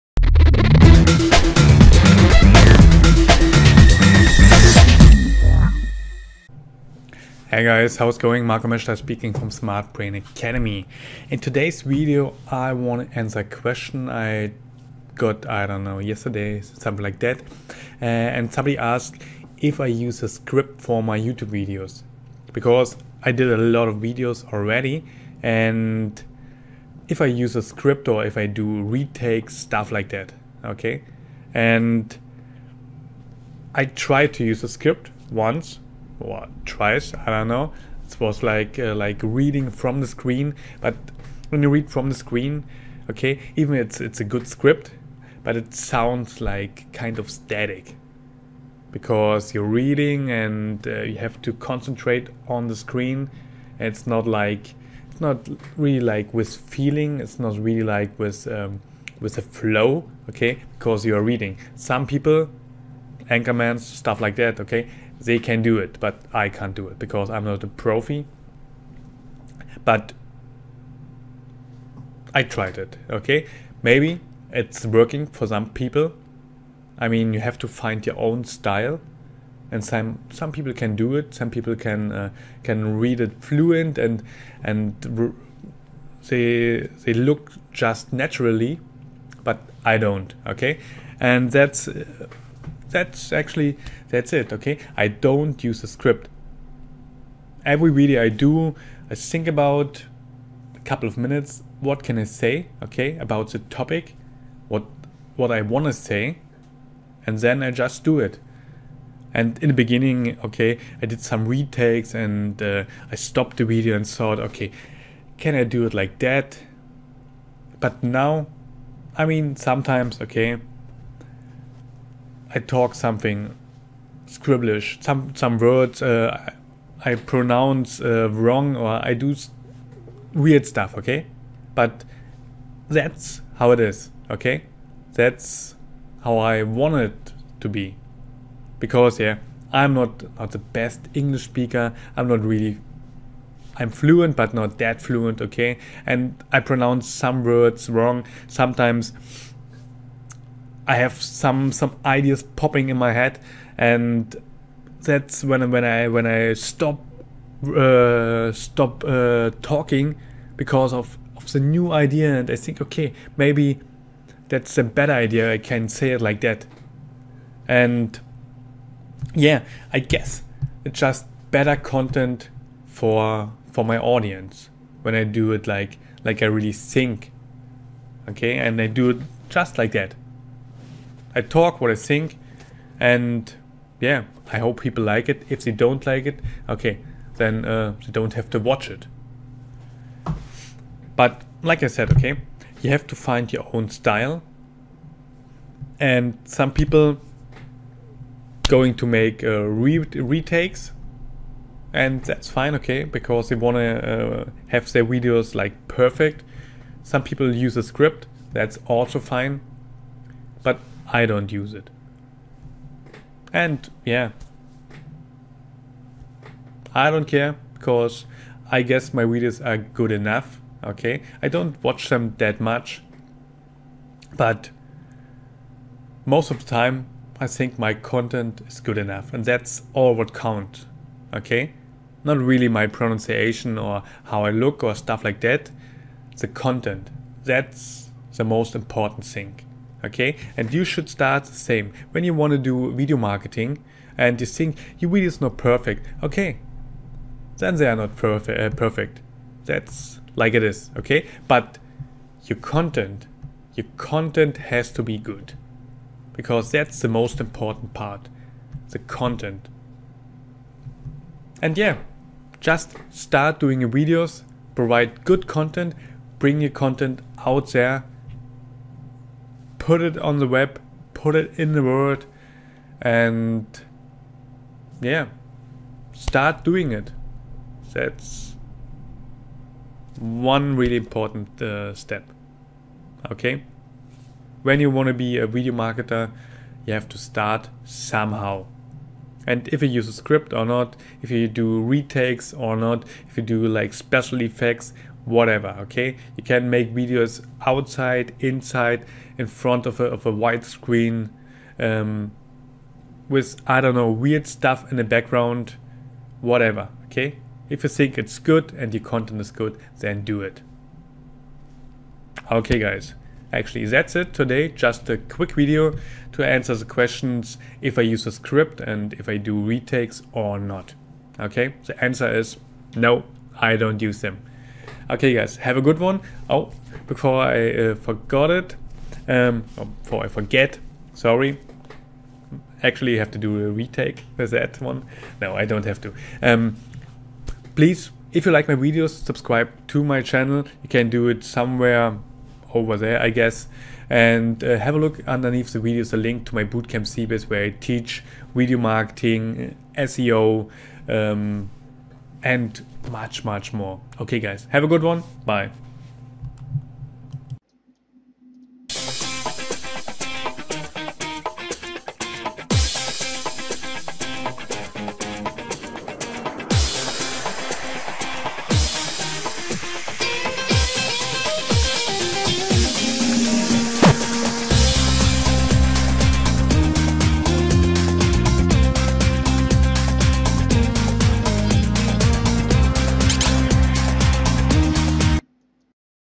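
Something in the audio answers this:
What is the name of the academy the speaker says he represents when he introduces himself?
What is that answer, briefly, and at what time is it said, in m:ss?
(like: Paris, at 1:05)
Smart Brain Academy, at 0:09.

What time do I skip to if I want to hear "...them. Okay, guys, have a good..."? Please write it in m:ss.
5:24.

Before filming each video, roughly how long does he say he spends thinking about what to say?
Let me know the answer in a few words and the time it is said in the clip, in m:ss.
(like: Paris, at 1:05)
a couple of minutes, at 1:40.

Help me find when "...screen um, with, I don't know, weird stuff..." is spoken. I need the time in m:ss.
5:00.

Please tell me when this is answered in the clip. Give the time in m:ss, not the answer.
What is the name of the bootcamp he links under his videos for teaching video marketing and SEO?
5:47.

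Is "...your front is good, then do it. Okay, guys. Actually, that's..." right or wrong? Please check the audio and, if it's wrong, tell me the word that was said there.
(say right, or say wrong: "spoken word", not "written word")
wrong: "content", not "front".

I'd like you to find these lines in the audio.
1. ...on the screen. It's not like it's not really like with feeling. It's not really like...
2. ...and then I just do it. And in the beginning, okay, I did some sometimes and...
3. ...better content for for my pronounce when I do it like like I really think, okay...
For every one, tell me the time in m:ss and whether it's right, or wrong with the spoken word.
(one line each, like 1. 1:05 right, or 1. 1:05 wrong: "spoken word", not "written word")
1. 0:52 right
2. 1:47 wrong: "retakes", not "sometimes"
3. 2:51 wrong: "audience", not "pronounce".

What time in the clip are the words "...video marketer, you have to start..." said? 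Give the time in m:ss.
4:45.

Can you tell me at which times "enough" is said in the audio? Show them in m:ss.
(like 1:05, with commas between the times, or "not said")
3:40, 3:48.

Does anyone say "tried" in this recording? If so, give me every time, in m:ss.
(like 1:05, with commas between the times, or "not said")
0:33, 1:12.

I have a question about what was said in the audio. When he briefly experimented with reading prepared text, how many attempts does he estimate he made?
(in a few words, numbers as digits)
once or twice.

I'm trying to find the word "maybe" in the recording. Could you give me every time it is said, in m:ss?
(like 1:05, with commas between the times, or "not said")
1:13, 2:43.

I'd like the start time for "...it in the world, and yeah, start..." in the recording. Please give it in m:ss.
4:31.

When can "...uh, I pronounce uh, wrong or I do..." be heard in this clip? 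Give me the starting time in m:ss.
2:06.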